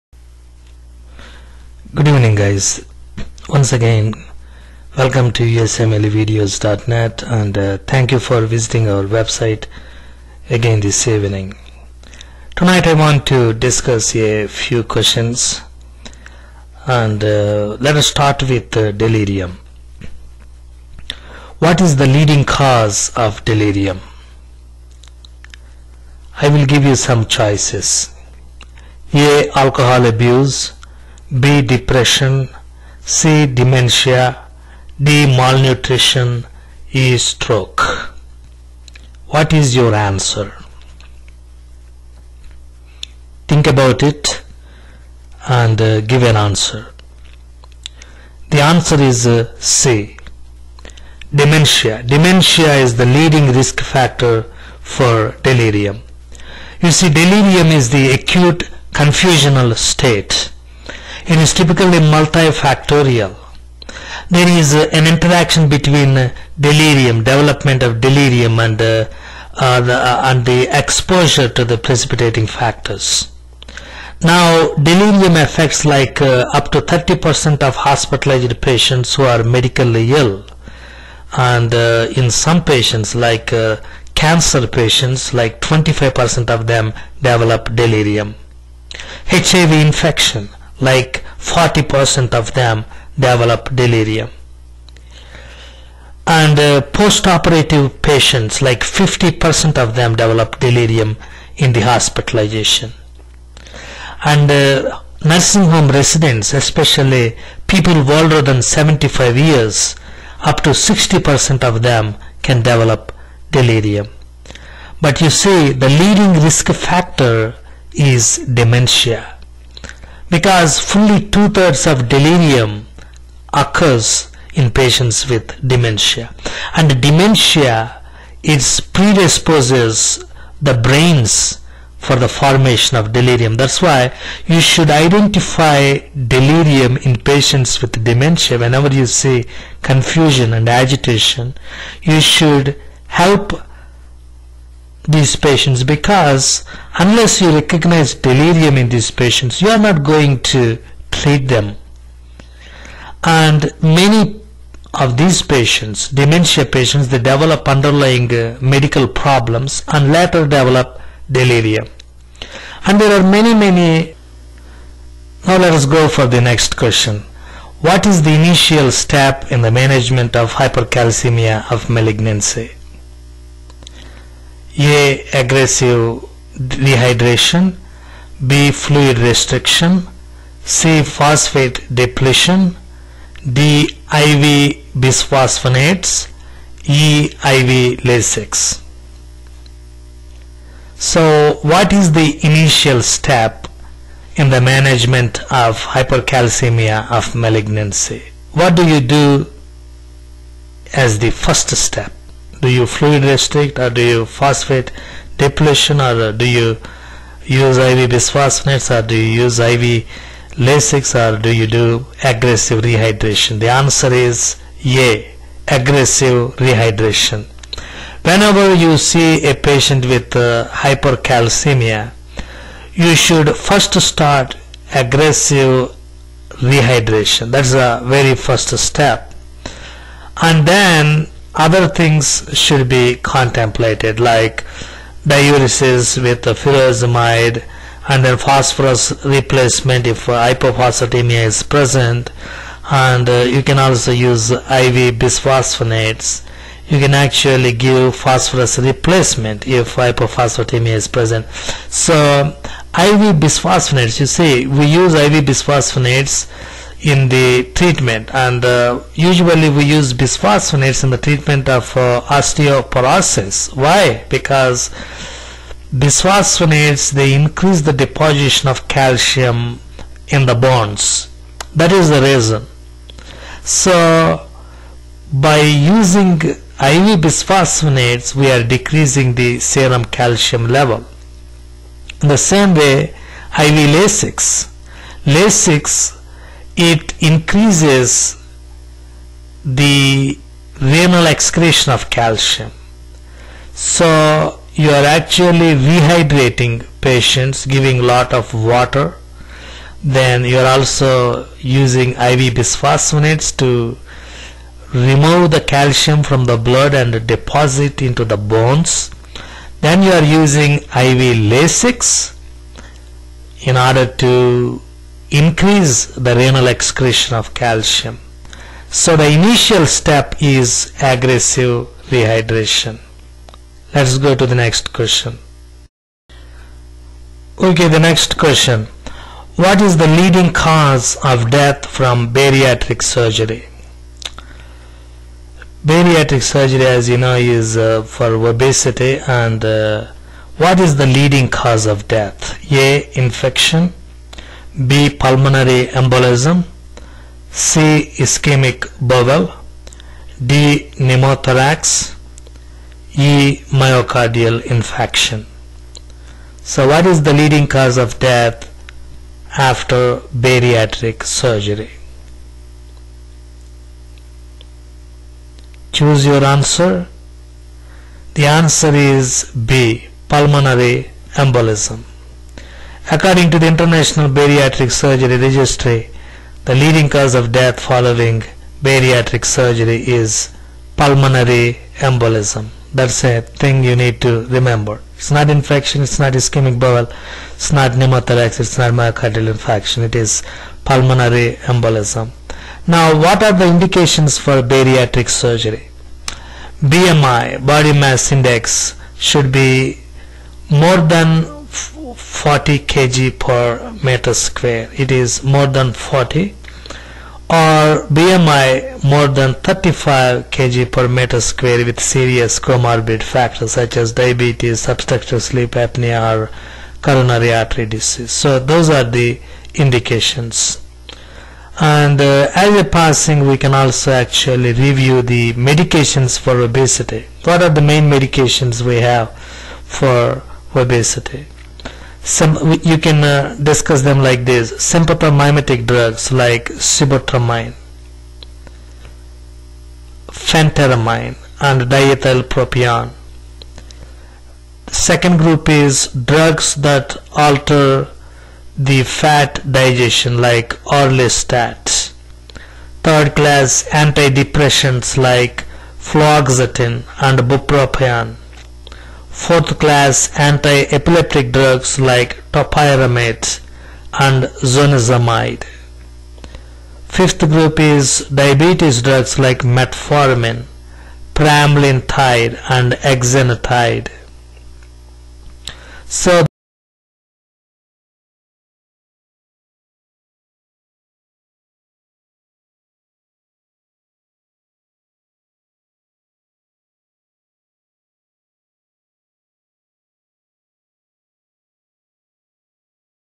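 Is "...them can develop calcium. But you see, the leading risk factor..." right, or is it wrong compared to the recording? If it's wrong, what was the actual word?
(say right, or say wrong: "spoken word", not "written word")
wrong: "delirium", not "calcium".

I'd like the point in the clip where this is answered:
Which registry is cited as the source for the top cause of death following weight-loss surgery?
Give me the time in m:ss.
6:13.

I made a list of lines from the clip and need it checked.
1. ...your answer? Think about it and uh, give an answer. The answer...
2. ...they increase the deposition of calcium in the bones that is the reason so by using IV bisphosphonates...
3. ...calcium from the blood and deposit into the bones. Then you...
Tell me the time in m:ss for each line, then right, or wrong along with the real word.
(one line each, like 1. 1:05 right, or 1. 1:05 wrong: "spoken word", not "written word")
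1. 0:39 right
2. 4:27 right
3. 5:05 right.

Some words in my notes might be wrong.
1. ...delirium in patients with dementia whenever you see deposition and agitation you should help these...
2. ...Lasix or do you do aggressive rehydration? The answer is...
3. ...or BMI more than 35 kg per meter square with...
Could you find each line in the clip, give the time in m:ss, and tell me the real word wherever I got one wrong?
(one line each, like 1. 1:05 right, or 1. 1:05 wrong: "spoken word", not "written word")
1. 2:16 wrong: "confusion", not "deposition"
2. 3:30 right
3. 6:47 right.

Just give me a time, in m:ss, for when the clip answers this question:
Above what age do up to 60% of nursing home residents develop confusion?
1:48.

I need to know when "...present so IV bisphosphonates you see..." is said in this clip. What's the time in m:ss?
4:11.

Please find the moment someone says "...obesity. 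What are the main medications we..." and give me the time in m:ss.
7:06.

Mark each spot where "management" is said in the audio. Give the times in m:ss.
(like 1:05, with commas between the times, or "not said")
2:49, 3:14.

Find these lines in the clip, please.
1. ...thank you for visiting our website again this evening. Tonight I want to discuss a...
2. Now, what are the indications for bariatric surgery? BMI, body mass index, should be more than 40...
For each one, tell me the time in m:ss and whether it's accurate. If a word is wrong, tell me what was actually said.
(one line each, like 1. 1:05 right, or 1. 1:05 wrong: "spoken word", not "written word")
1. 0:07 right
2. 6:32 right.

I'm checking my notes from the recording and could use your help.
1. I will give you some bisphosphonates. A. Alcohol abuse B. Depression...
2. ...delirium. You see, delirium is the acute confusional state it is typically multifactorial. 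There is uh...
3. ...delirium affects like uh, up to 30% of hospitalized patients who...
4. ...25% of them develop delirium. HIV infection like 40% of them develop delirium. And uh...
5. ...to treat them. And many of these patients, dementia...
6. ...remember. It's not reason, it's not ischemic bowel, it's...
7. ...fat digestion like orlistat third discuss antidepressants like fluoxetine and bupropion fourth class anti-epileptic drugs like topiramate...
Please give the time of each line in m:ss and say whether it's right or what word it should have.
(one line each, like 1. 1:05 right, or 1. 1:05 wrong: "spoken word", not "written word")
1. 0:26 wrong: "choices", not "bisphosphonates"
2. 0:55 right
3. 1:14 right
4. 1:25 right
5. 2:30 right
6. 6:24 wrong: "infection", not "reason"
7. 7:29 wrong: "class", not "discuss".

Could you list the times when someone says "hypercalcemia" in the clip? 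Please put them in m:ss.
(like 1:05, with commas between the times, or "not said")
2:50, 3:15, 3:40.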